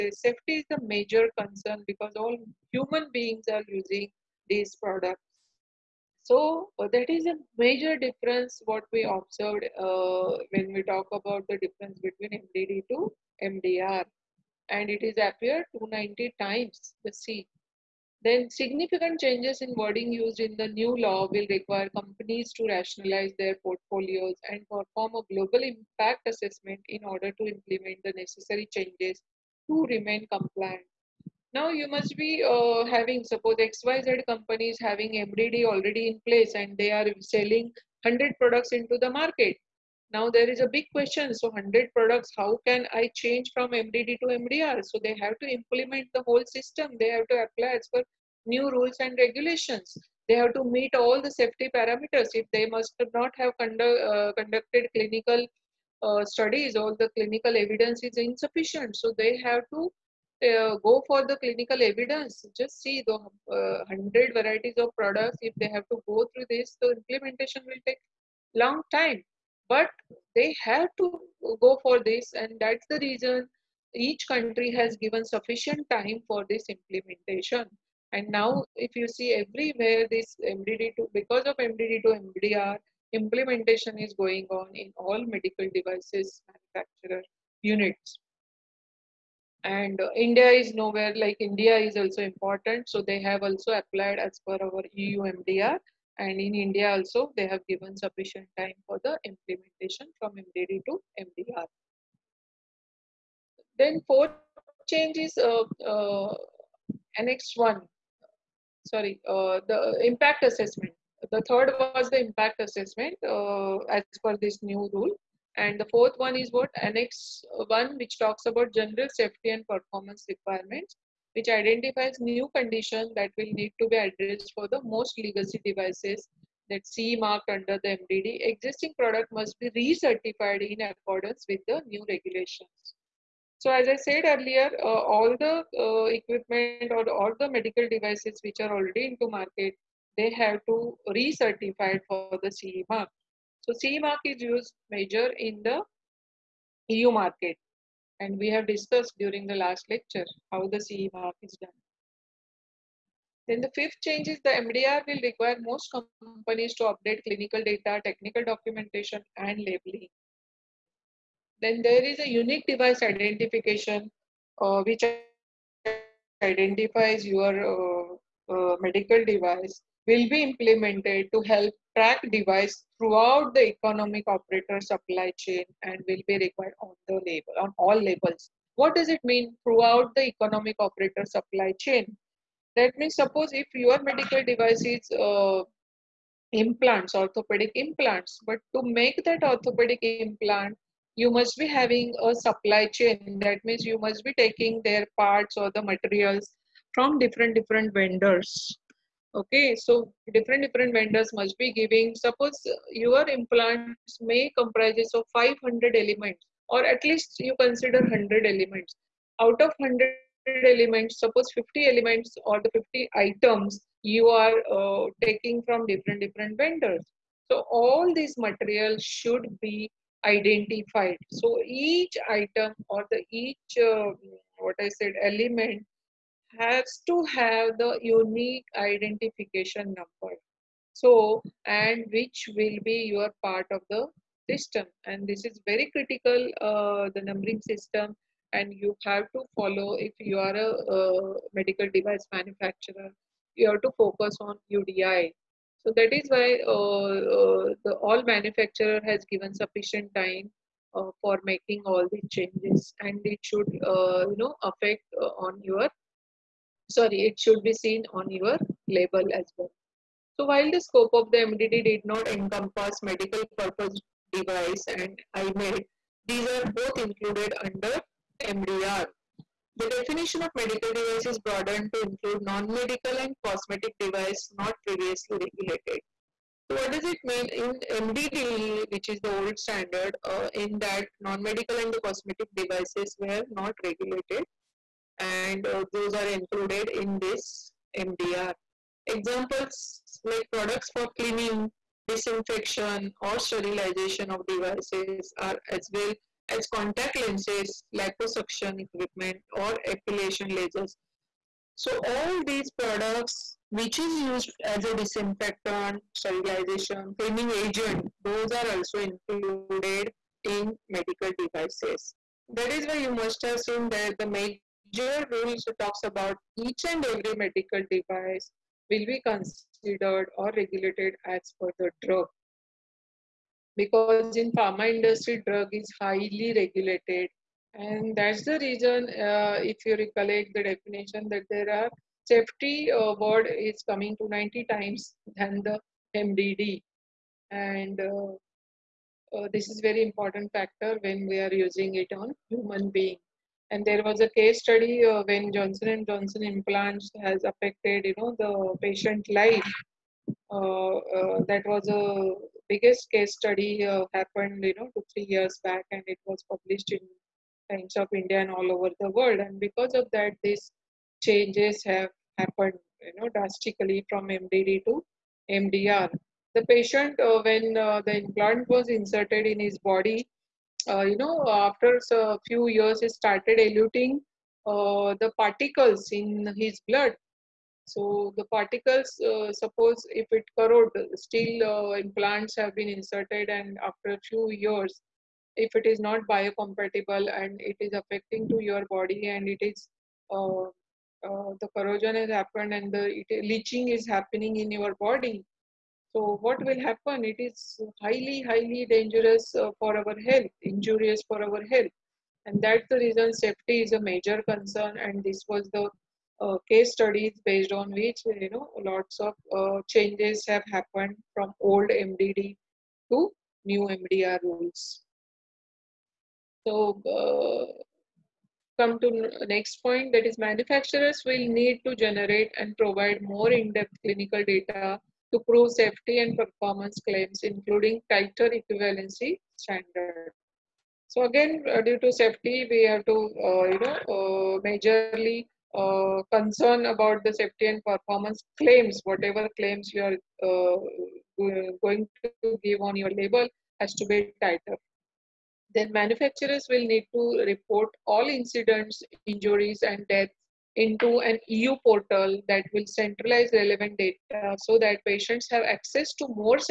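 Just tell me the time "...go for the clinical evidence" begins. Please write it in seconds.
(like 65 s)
60 s.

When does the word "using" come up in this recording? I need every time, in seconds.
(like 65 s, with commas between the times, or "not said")
3 s, 341 s.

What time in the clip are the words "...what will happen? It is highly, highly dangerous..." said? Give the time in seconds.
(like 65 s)
396 s.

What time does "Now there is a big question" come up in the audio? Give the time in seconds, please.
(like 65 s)
40 s.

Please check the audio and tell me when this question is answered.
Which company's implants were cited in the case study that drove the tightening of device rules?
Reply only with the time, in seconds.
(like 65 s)
345 s.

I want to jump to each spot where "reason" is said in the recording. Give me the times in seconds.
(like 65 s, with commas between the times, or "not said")
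72 s, 328 s, 402 s.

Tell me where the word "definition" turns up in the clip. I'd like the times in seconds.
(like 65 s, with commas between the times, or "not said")
269 s, 330 s.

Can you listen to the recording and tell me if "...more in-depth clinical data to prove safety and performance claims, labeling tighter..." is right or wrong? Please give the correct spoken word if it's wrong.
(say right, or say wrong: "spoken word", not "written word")
wrong: "including", not "labeling".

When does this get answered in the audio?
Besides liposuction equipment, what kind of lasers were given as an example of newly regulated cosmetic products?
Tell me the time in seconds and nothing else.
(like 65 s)
299 s.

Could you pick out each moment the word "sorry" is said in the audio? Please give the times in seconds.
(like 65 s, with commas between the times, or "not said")
108 s, 256 s.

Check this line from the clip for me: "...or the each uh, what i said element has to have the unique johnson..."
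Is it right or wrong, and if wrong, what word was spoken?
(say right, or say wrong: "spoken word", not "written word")
wrong: "identification", not "johnson".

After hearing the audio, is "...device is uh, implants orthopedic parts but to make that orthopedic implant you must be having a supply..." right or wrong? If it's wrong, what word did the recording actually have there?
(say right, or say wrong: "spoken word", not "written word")
wrong: "implants", not "parts".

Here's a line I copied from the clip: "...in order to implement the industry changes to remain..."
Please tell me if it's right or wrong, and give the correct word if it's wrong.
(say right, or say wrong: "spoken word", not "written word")
wrong: "necessary", not "industry".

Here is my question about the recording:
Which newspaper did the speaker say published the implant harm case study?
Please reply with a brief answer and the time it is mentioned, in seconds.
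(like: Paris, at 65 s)
Times of India, at 357 s.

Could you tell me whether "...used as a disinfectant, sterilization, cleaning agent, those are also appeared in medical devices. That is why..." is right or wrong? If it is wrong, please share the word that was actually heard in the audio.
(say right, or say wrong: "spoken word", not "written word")
wrong: "included", not "appeared".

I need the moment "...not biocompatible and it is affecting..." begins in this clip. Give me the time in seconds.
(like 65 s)
385 s.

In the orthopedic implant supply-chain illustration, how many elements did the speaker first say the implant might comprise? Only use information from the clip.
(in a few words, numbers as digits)
500.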